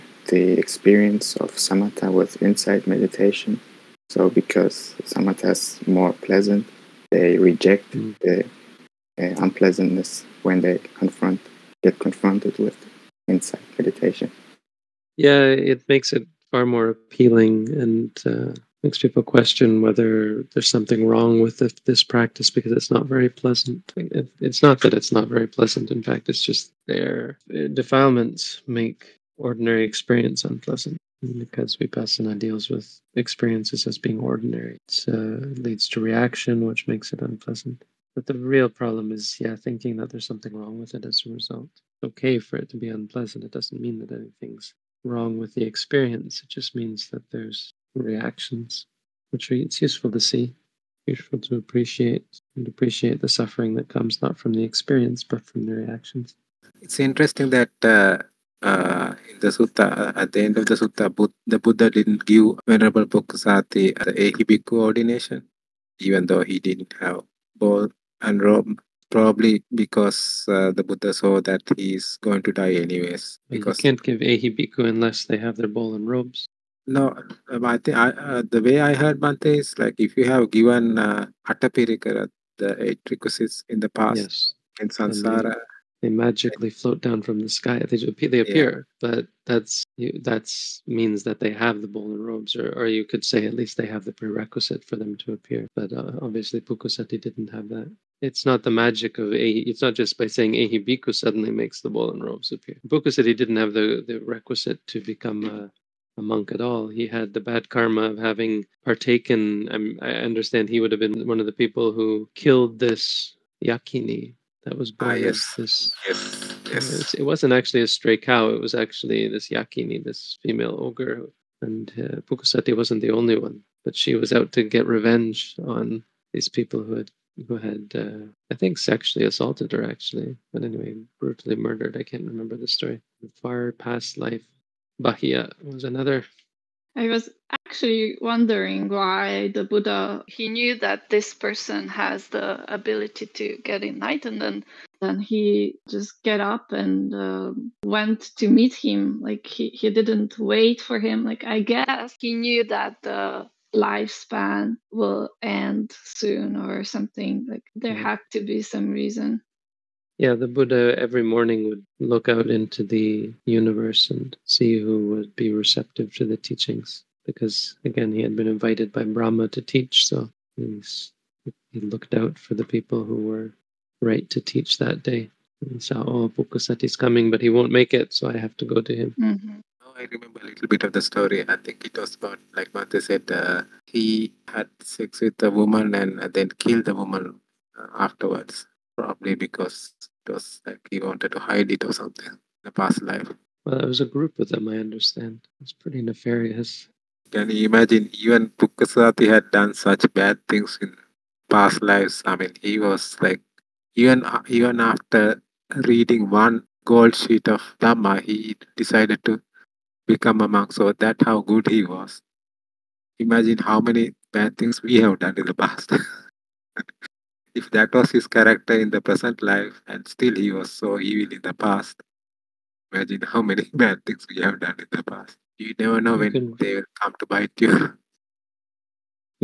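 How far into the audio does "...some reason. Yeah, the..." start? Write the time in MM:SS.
02:38.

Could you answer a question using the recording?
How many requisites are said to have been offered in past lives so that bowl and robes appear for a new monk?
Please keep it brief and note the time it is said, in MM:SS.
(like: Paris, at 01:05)
8, at 01:22.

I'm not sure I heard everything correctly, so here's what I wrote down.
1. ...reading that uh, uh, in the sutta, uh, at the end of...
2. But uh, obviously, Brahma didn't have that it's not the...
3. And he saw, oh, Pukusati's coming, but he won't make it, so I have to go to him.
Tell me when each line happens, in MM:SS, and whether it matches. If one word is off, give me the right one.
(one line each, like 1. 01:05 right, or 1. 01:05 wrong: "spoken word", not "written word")
1. 00:56 wrong: "interesting", not "reading"
2. 01:35 wrong: "Pukusati", not "Brahma"
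3. 02:55 right.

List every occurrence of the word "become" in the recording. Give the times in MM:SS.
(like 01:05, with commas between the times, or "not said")
01:45, 03:30.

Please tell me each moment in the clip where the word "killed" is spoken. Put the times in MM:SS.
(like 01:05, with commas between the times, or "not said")
01:52, 03:06.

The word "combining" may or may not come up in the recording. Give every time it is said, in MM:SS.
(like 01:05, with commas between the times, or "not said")
not said.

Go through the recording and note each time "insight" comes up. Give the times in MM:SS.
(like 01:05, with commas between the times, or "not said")
00:02, 00:13.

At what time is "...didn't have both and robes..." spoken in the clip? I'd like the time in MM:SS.
01:06.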